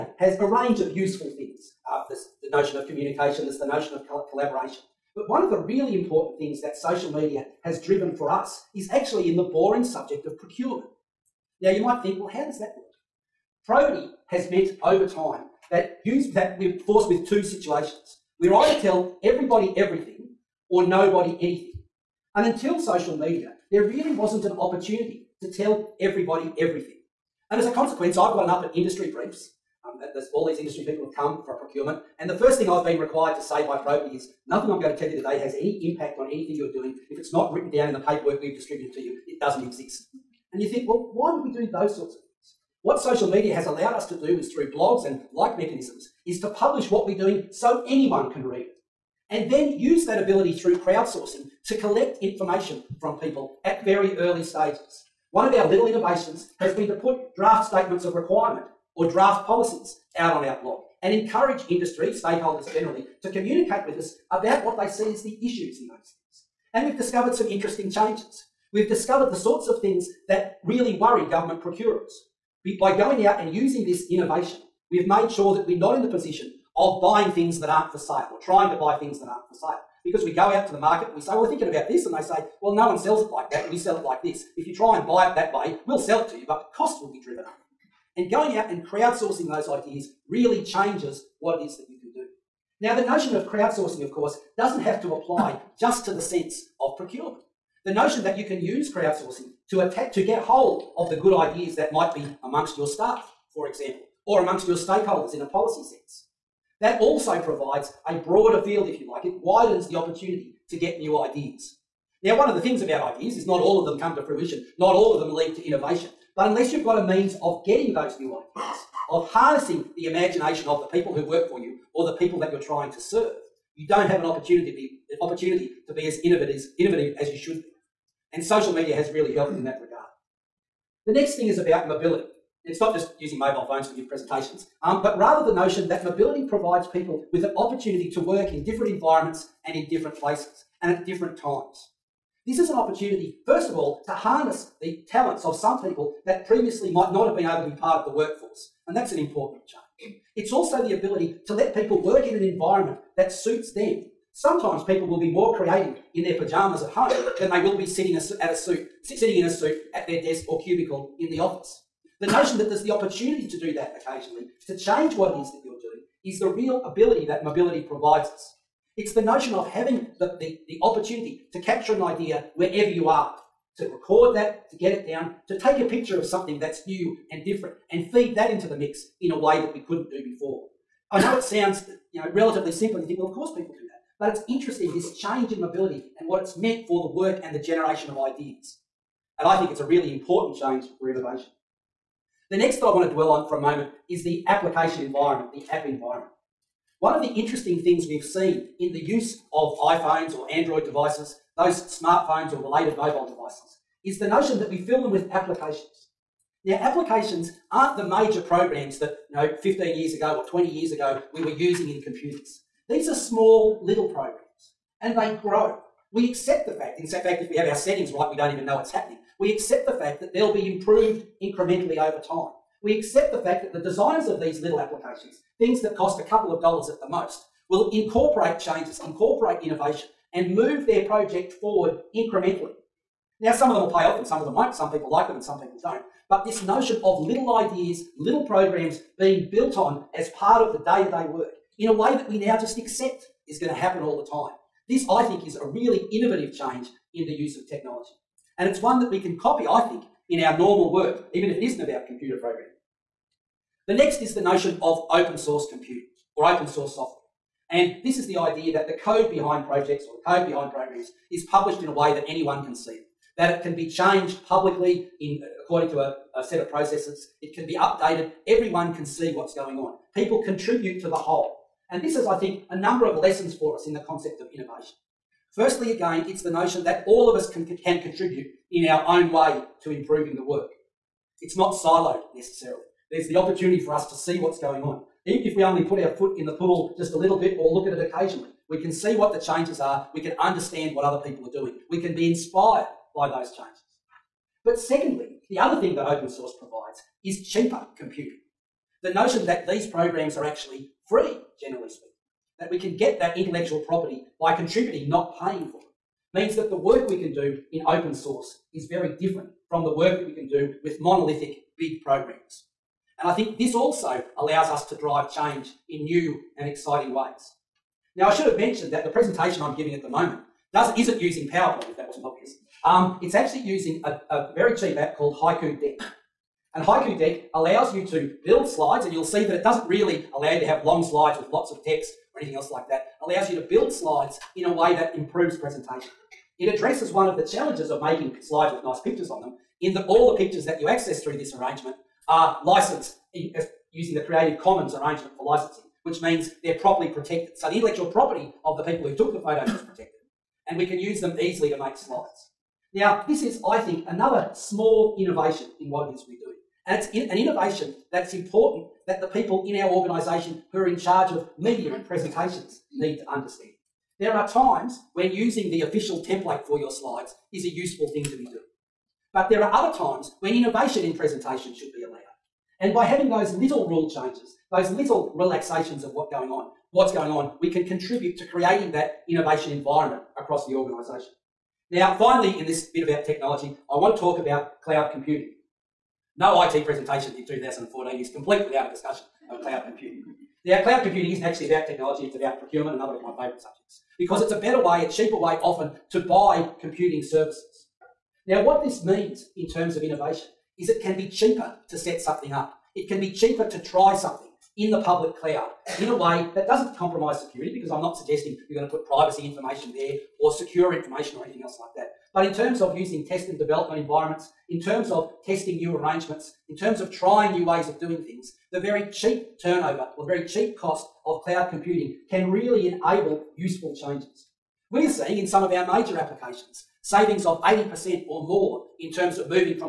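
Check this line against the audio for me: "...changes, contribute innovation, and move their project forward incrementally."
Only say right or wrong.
wrong.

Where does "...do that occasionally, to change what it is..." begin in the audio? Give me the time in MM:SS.
02:43.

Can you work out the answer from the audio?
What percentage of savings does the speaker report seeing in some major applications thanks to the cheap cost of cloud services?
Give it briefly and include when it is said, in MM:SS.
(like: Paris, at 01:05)
80%, at 07:07.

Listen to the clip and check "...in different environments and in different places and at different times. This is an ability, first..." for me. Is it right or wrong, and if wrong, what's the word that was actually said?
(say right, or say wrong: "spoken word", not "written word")
wrong: "opportunity", not "ability".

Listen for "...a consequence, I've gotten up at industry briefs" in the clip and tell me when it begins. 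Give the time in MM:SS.
00:27.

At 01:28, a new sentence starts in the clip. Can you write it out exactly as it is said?
And going out and crowdsourcing those ideas really changes what it is that you can do.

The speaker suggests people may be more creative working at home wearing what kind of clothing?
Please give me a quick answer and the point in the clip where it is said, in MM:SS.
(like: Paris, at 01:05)
pajamas, at 02:36.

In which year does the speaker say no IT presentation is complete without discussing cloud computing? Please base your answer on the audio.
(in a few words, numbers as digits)
2014.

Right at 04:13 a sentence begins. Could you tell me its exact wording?
The next is the notion of open source computing or open source software.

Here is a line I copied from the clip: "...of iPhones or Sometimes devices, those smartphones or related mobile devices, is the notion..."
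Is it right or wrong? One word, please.
wrong.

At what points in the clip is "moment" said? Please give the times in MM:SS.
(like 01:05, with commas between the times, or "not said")
03:13, 05:20.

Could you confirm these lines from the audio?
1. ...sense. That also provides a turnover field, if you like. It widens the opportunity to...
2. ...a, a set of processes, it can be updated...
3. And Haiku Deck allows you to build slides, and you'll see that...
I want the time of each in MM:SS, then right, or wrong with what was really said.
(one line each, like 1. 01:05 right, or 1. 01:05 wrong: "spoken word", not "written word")
1. 01:45 wrong: "broader", not "turnover"
2. 04:25 right
3. 05:26 right.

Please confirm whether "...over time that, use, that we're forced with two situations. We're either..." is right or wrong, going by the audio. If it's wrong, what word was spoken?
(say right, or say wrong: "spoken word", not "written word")
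right.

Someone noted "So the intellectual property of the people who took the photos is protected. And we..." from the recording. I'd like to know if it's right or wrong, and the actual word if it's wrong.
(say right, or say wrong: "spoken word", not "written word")
right.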